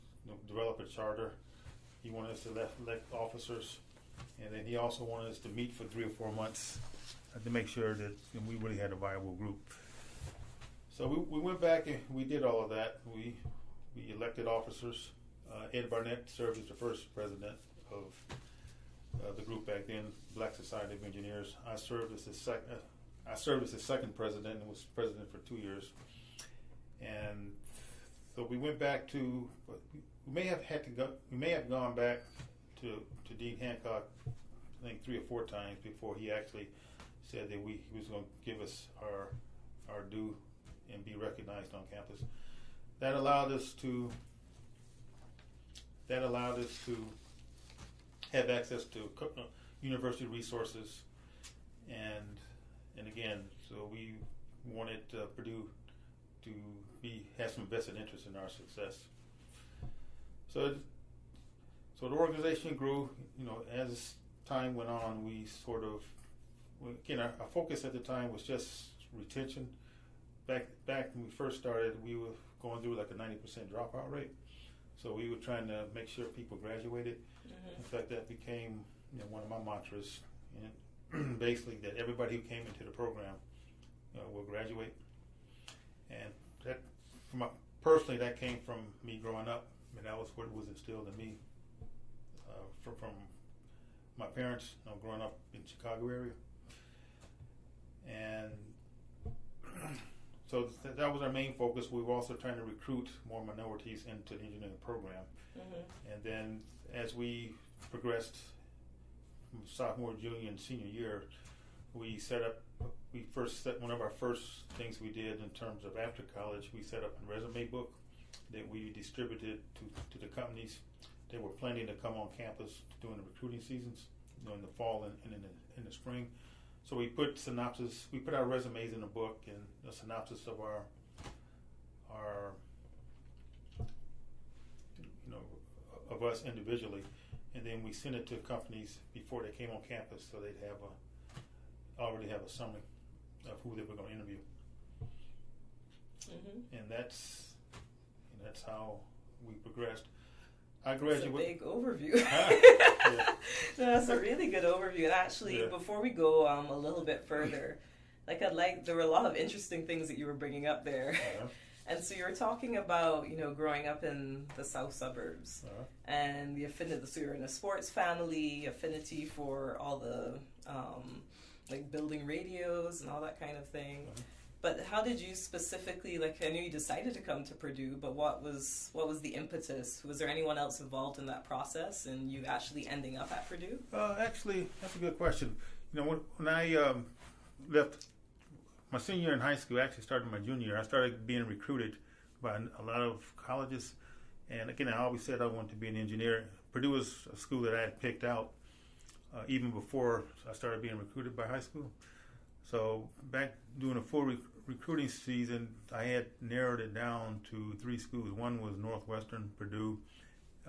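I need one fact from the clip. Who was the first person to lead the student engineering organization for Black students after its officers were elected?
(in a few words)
Ed Barnett.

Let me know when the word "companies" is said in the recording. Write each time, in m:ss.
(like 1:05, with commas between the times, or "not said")
2:00, 2:18.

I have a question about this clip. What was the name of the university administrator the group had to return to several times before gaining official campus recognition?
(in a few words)
Dean Hancock.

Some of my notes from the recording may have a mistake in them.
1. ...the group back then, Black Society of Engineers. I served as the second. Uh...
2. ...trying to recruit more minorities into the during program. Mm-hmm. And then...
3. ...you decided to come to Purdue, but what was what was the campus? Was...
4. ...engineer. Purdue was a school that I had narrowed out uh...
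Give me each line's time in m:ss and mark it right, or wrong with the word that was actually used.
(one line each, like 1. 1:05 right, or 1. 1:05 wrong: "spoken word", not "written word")
1. 0:19 right
2. 1:42 wrong: "engineering", not "during"
3. 2:56 wrong: "impetus", not "campus"
4. 3:15 wrong: "picked", not "narrowed".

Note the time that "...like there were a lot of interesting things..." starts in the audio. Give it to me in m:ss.
2:38.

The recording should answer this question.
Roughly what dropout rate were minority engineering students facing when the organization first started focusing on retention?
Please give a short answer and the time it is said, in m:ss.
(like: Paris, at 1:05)
90 percent, at 1:13.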